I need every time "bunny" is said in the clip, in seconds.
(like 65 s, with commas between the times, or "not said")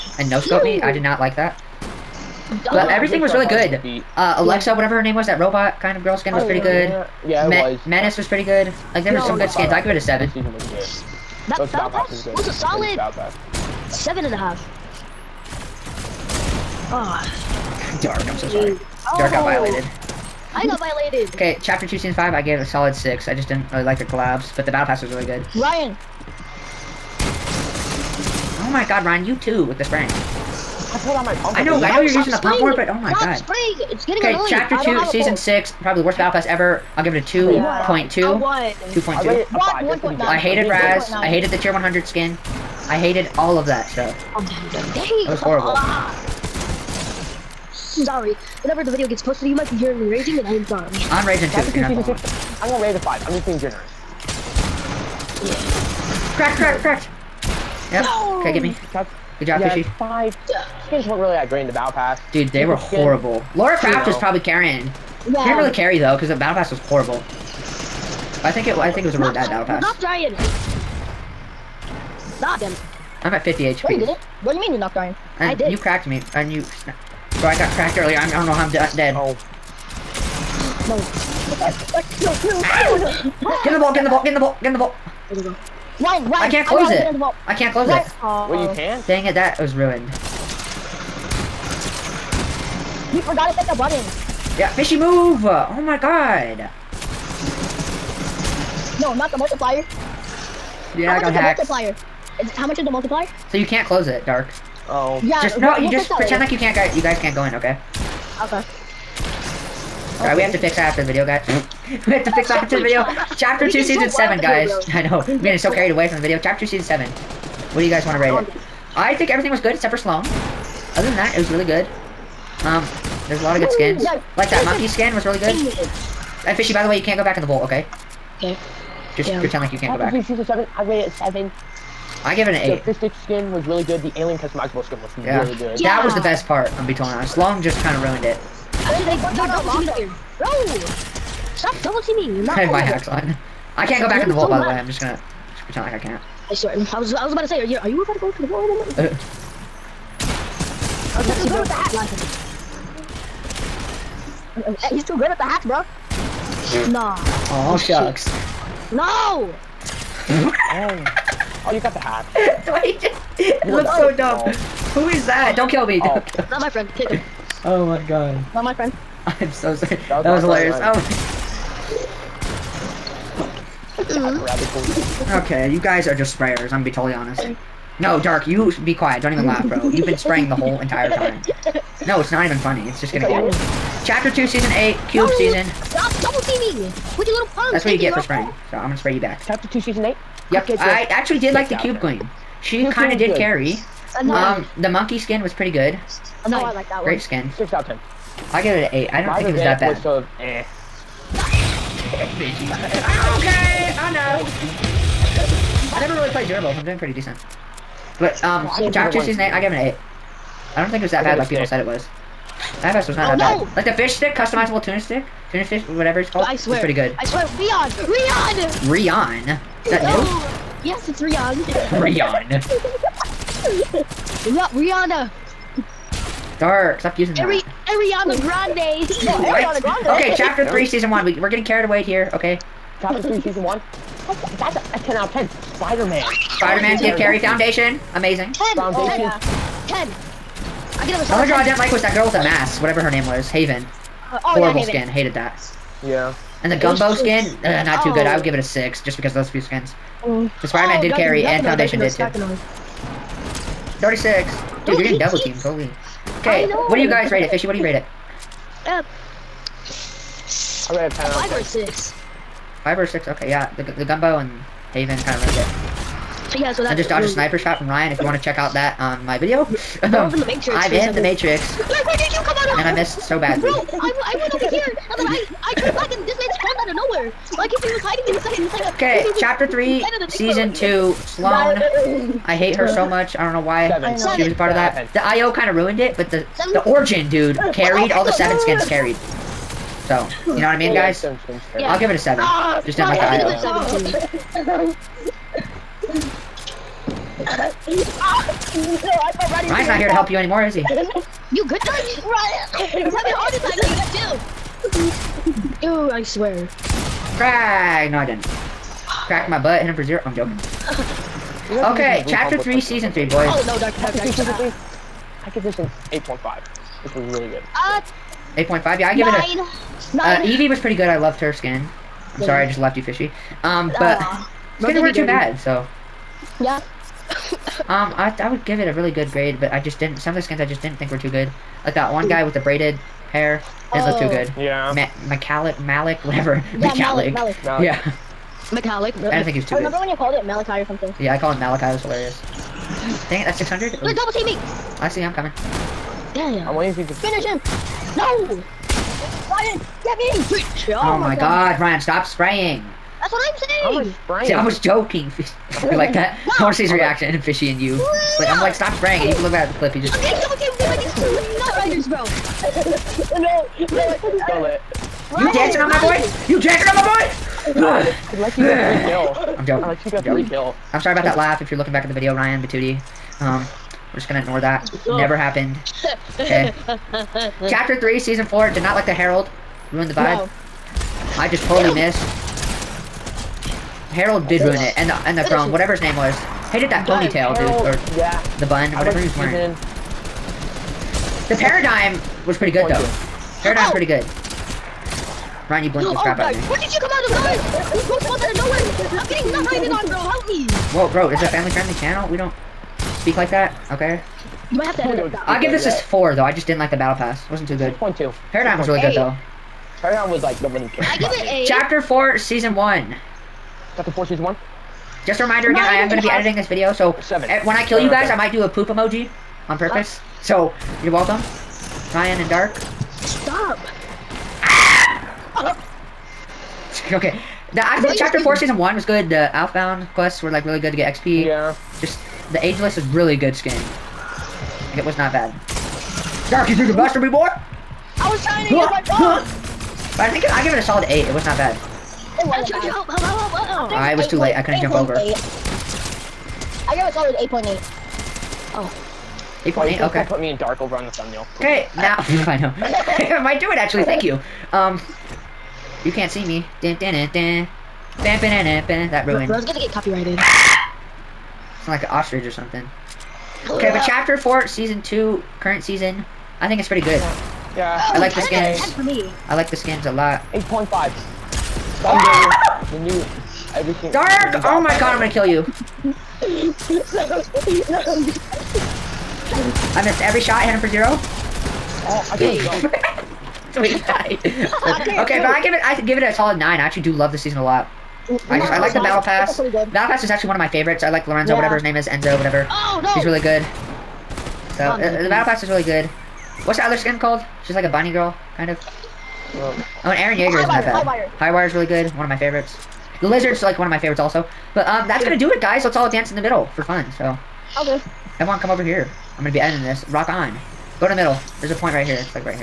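497 s.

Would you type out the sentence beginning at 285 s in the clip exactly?
The IO kind of ruined it, but the Seven.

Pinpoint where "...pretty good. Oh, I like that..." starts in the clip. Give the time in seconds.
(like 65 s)
195 s.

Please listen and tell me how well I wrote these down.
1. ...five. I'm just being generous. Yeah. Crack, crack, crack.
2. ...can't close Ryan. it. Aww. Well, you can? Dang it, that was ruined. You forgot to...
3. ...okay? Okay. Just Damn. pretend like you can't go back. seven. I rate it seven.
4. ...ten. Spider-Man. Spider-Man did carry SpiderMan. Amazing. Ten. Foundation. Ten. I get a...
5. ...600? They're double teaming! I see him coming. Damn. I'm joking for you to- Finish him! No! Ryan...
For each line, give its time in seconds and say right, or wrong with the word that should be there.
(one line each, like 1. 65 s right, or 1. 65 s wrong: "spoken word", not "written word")
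1. 52 s right
2. 87 s right
3. 127 s right
4. 235 s wrong: "Foundation", not "SpiderMan"
5. 343 s wrong: "waiting", not "joking".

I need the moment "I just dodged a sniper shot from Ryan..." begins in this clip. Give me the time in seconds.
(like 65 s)
266 s.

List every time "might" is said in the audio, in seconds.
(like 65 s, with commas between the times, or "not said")
49 s, 404 s, 418 s, 453 s.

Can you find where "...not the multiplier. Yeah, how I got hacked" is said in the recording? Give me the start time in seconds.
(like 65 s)
99 s.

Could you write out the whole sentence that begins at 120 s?
Other than that, it was really good.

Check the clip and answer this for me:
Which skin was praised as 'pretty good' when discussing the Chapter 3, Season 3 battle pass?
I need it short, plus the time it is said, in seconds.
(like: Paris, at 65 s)
Evie, at 320 s.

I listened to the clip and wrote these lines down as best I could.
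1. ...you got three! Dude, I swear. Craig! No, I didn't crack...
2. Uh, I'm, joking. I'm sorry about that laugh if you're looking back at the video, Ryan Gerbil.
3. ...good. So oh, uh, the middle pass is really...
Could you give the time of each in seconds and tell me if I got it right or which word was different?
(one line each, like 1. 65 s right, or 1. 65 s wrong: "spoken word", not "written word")
1. 304 s wrong: "two", not "three"
2. 369 s wrong: "Batuti", not "Gerbil"
3. 493 s wrong: "battle", not "middle".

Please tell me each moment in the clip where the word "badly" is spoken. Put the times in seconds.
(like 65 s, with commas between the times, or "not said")
273 s.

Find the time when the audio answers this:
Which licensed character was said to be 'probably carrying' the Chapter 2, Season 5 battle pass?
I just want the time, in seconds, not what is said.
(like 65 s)
63 s.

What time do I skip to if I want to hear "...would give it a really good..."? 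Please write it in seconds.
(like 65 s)
328 s.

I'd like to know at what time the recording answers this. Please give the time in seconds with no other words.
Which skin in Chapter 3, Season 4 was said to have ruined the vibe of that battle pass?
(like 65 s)
379 s.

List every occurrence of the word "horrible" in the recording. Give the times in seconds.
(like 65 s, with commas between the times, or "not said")
45 s, 62 s, 66 s, 244 s.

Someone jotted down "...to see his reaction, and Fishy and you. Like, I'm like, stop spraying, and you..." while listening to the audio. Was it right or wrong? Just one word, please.
right.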